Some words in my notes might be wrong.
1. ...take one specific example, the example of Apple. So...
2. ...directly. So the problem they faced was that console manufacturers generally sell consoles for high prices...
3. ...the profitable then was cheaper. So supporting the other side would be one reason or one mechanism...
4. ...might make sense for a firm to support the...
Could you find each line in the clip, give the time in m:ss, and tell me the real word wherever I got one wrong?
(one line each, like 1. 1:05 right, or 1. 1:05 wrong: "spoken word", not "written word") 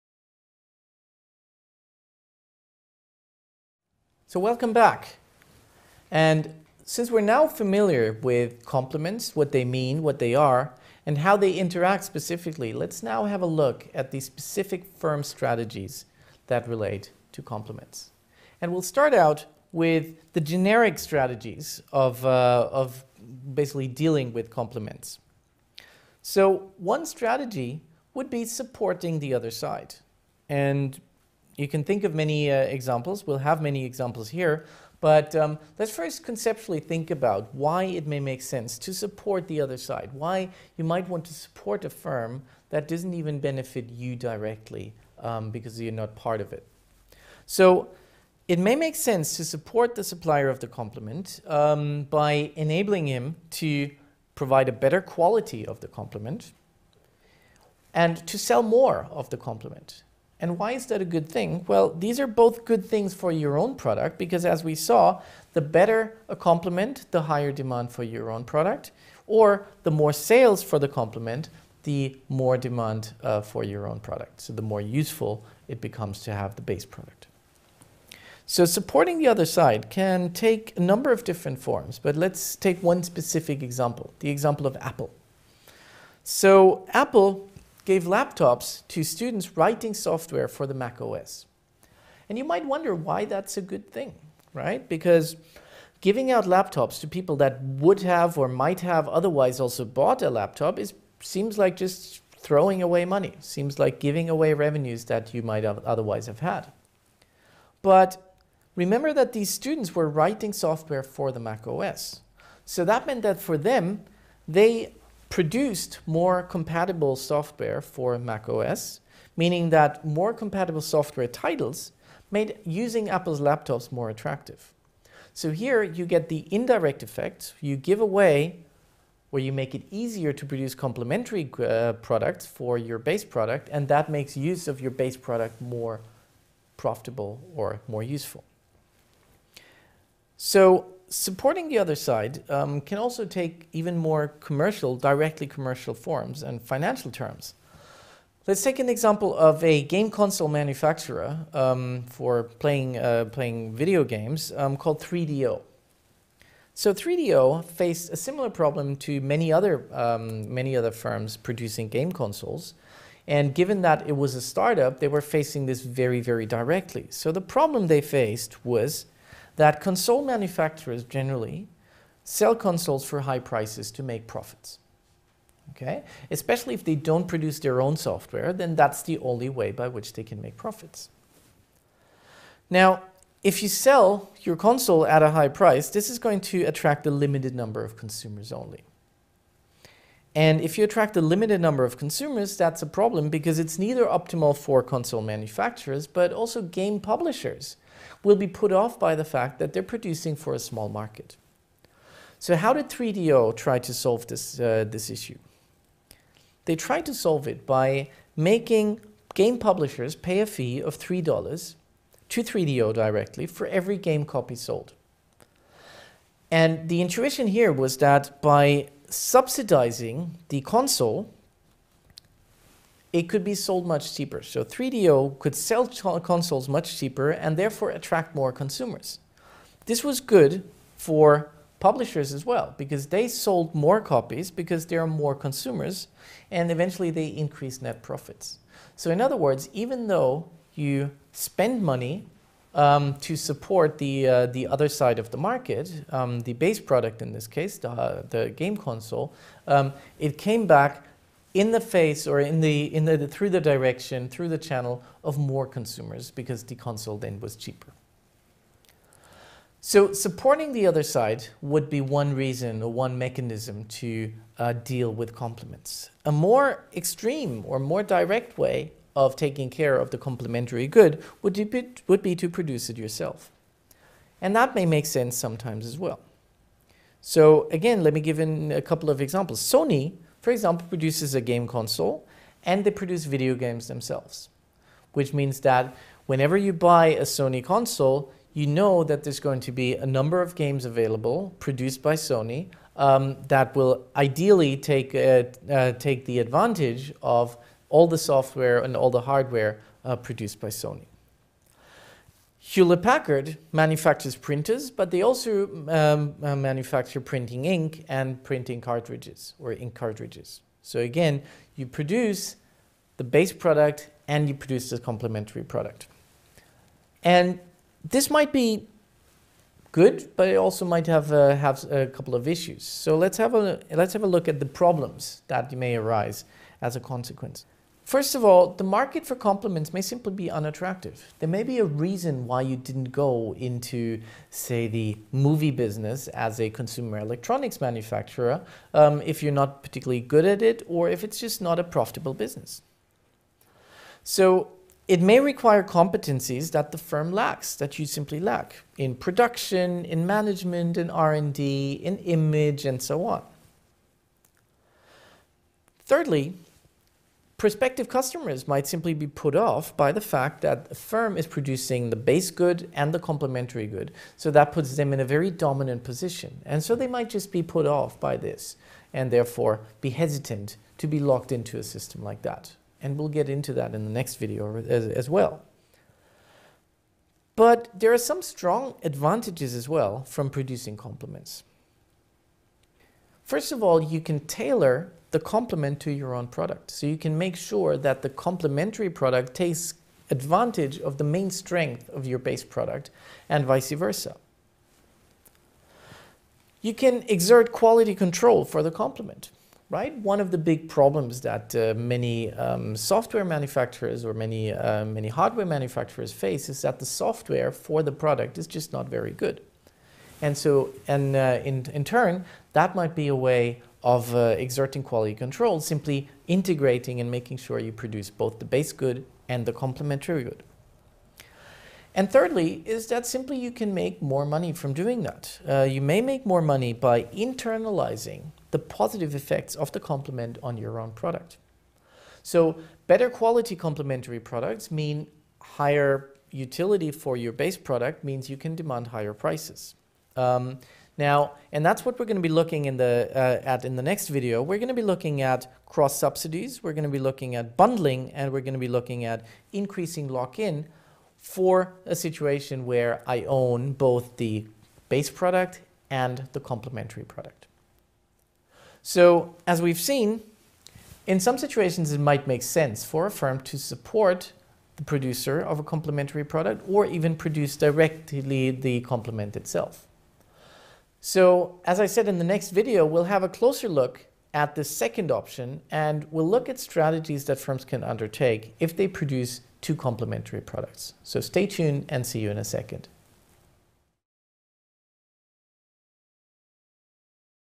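1. 1:22 right
2. 2:46 right
3. 4:16 wrong: "console", not "profitable"
4. 7:42 right.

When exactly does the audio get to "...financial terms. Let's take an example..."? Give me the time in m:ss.
2:26.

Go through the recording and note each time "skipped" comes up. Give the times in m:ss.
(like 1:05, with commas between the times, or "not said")
not said.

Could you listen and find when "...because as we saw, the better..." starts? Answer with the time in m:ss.
1:04.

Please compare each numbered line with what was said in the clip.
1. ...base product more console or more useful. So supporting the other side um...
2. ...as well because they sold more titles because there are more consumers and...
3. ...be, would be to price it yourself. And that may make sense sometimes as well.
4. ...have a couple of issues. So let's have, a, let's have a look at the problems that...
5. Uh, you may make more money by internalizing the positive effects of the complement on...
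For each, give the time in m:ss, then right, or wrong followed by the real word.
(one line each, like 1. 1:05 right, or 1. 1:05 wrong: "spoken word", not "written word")
1. 2:14 wrong: "profitable", not "console"
2. 3:52 wrong: "copies", not "titles"
3. 4:31 wrong: "produce", not "price"
4. 5:21 right
5. 7:05 right.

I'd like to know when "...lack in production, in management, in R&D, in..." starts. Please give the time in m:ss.
5:48.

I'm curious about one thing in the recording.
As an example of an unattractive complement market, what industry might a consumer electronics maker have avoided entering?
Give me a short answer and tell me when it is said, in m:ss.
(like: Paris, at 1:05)
movie business, at 5:34.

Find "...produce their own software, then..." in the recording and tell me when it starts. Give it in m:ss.
2:57.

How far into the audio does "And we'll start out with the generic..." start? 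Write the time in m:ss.
0:18.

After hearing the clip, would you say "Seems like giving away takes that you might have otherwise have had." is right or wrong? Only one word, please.
wrong.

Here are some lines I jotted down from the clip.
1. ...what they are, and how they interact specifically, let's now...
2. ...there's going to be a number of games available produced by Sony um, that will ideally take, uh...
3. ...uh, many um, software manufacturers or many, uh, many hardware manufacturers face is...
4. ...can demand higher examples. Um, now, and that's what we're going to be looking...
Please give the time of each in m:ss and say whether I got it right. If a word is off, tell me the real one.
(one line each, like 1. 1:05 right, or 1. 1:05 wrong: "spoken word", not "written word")
1. 0:10 right
2. 4:49 right
3. 6:41 right
4. 7:18 wrong: "prices", not "examples".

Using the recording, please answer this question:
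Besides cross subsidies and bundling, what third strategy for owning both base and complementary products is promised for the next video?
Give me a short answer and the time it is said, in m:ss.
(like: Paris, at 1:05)
increasing lock-in, at 7:29.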